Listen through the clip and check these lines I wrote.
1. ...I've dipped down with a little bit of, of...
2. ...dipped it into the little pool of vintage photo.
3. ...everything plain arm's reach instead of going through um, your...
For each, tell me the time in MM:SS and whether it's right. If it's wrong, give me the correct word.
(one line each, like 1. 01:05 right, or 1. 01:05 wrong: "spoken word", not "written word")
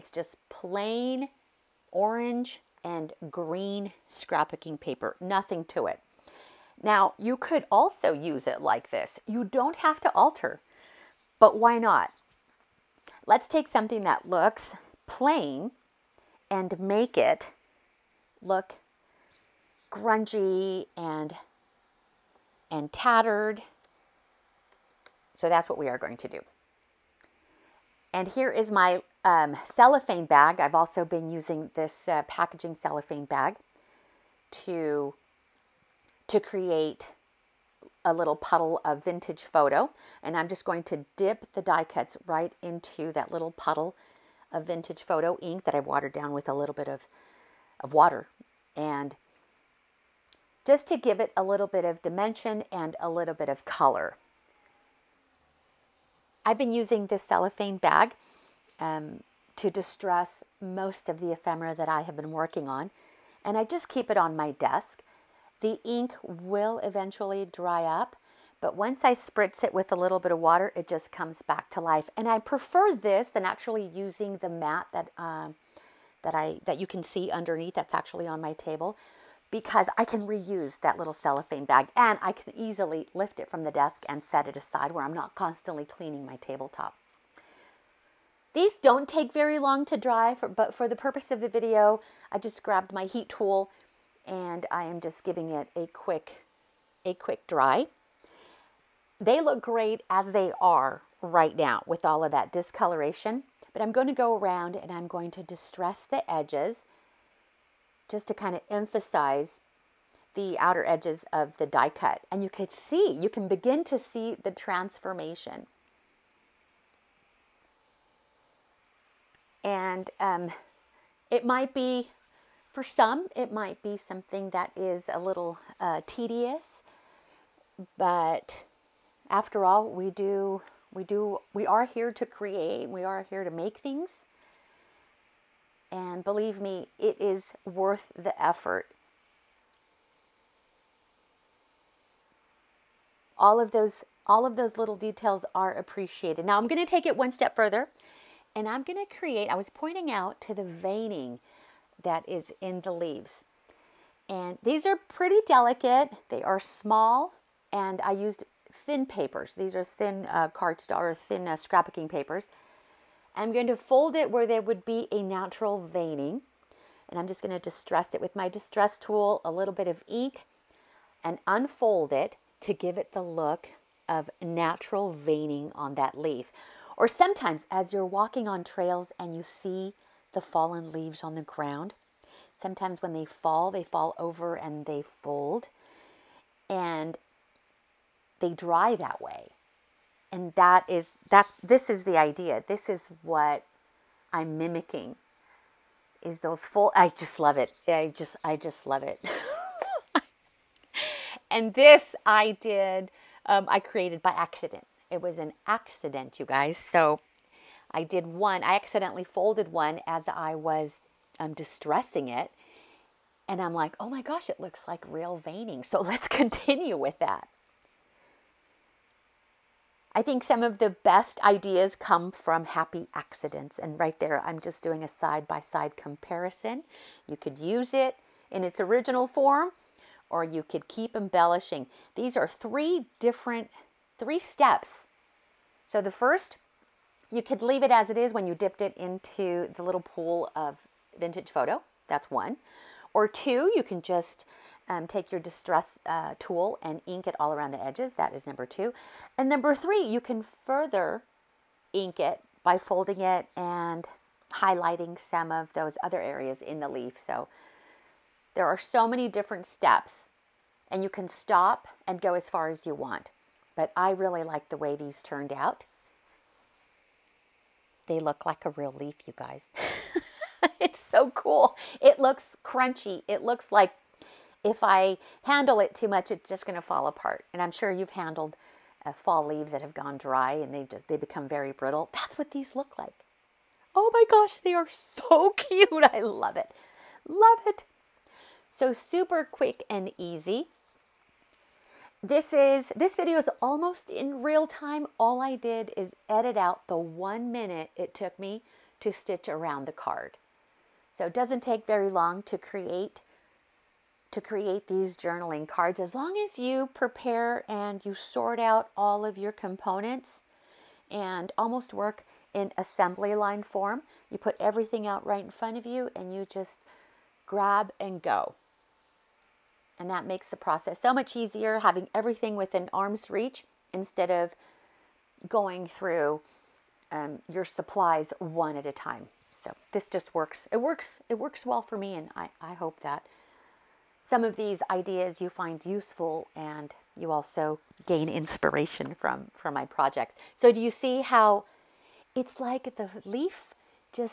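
1. 00:45 wrong: "watered", not "dipped"
2. 03:58 right
3. 05:22 wrong: "within", not "plain".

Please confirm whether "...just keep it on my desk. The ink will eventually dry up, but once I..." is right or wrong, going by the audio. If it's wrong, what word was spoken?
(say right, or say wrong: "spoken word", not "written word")
right.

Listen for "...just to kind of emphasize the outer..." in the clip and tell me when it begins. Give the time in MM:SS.
01:48.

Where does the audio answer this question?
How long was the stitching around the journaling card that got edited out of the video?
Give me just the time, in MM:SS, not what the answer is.
04:56.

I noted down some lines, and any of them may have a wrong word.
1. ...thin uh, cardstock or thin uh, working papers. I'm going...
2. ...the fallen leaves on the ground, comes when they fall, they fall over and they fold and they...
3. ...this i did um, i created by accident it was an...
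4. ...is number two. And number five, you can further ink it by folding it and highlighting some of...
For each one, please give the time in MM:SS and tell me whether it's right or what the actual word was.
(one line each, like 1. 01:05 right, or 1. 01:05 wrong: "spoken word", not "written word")
1. 02:39 wrong: "scrapbooking", not "working"
2. 03:00 wrong: "sometimes", not "comes"
3. 03:21 right
4. 04:08 wrong: "three", not "five".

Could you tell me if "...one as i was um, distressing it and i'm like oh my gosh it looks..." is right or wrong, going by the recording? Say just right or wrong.
right.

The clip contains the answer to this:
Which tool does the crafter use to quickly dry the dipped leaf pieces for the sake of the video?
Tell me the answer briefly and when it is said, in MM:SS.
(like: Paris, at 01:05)
heat tool, at 01:33.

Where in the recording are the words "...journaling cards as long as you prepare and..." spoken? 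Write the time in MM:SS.
05:05.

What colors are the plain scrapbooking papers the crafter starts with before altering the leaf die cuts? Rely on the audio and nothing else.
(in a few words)
orange and green.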